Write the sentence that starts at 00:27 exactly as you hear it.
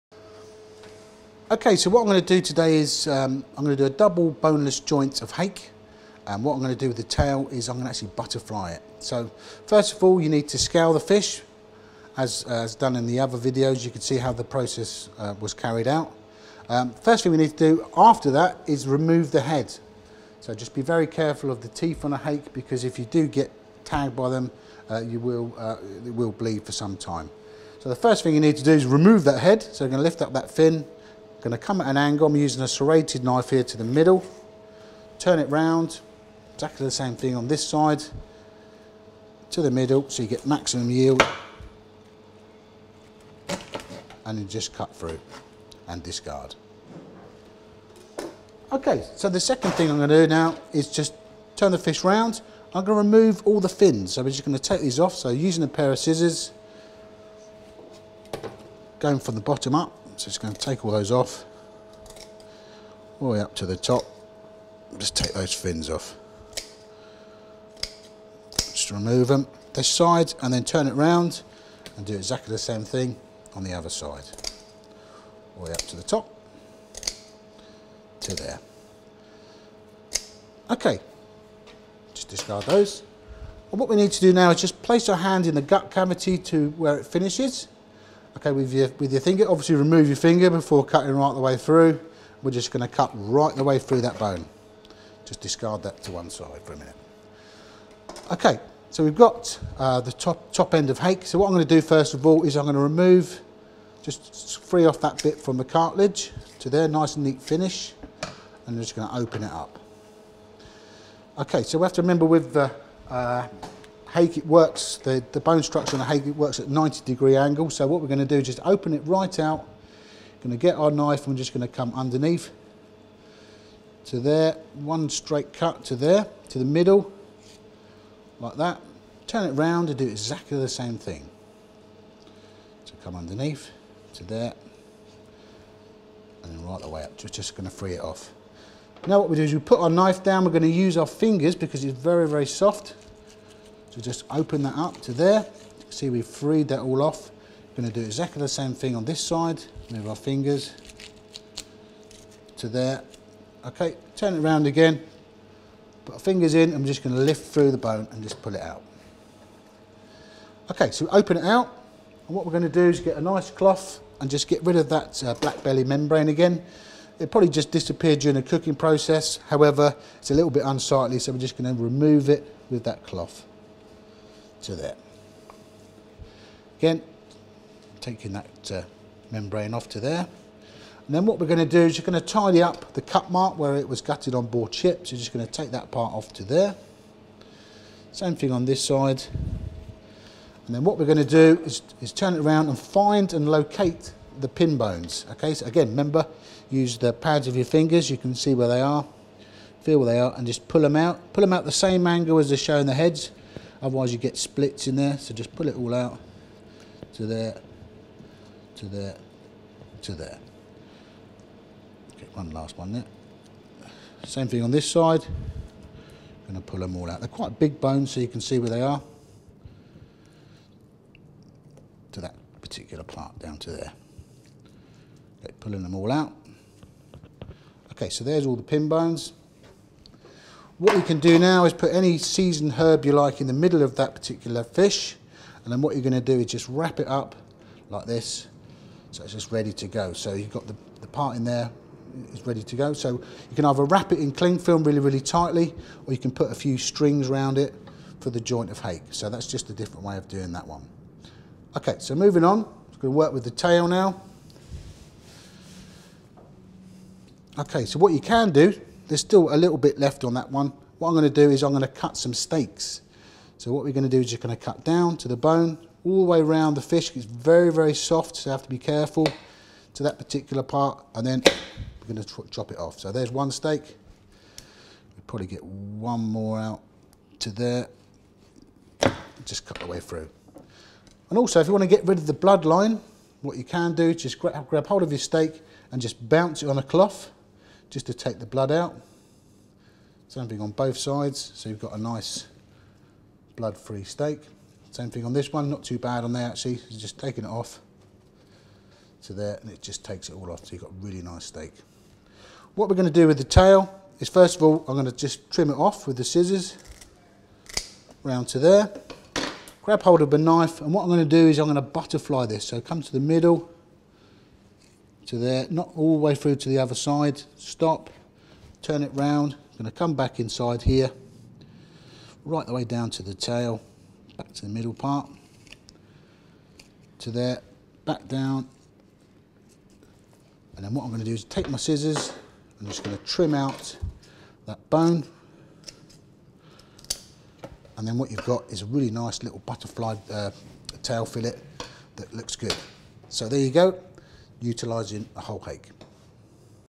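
So the first thing you need to do is remove that head.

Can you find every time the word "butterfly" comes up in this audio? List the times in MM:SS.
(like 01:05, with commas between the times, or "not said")
00:08, 05:11, 05:39.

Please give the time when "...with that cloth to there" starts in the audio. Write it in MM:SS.
02:52.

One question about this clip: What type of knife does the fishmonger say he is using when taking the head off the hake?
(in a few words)
Serrated knife.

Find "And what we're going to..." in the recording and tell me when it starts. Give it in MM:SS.
02:42.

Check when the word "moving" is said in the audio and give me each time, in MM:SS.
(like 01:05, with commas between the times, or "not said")
04:12.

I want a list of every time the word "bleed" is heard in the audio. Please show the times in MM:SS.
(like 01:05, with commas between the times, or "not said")
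00:26.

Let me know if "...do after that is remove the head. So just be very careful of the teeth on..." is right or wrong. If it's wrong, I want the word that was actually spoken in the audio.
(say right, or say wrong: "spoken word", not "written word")
right.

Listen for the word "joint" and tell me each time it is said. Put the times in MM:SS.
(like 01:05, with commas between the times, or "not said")
00:04, 04:08.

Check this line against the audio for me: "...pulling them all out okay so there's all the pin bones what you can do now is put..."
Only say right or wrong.
right.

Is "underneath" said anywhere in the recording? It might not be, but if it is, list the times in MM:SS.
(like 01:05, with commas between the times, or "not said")
02:01, 02:13.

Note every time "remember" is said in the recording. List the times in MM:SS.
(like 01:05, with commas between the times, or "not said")
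01:52, 03:15.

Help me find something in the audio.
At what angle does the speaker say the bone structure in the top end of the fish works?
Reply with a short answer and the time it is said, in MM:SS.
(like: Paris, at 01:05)
90 degrees, at 01:56.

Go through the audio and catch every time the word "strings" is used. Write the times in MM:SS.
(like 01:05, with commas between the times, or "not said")
04:06.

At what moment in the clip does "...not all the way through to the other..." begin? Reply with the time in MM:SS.
05:15.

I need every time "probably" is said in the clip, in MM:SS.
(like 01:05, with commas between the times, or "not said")
02:47, 04:35.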